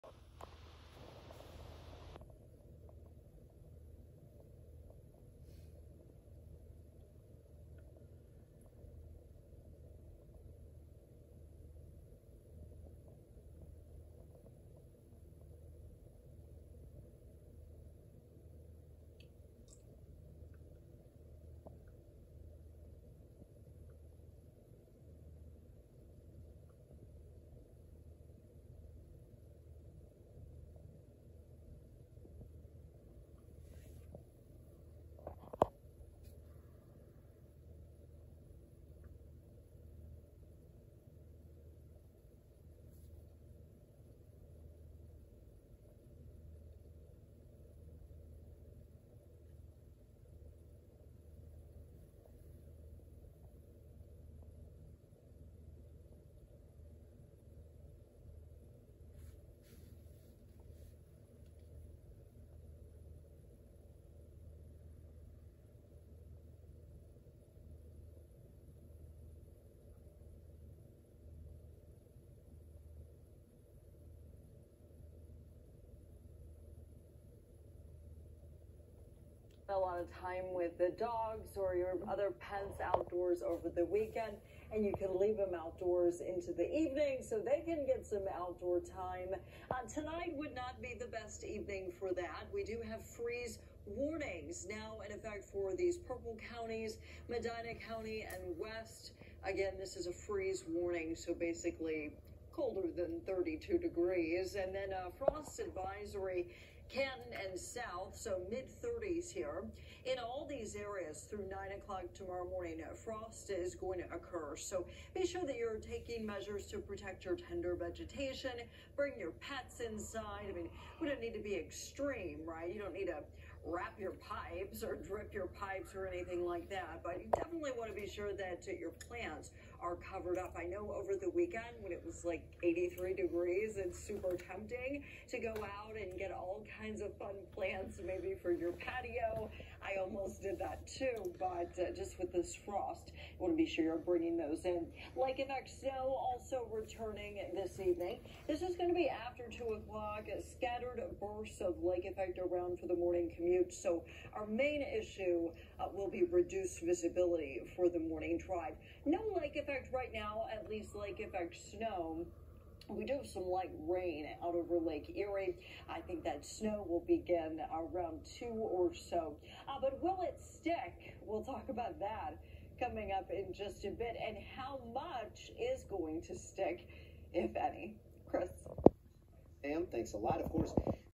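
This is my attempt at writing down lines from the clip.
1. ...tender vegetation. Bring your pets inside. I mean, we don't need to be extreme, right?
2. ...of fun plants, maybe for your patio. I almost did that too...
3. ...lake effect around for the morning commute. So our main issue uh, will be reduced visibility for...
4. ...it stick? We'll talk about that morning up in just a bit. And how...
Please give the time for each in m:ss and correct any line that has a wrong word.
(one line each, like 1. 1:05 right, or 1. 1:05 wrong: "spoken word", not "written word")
1. 1:57 right
2. 2:17 right
3. 2:31 right
4. 2:50 wrong: "coming", not "morning".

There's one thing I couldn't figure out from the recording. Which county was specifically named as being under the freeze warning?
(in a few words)
Medina County.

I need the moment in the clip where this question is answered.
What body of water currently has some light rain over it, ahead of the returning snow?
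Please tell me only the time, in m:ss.
2:44.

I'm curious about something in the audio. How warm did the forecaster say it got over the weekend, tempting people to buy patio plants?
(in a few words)
83 degrees.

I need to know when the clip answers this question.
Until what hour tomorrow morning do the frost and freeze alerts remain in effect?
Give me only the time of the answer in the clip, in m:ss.
1:51.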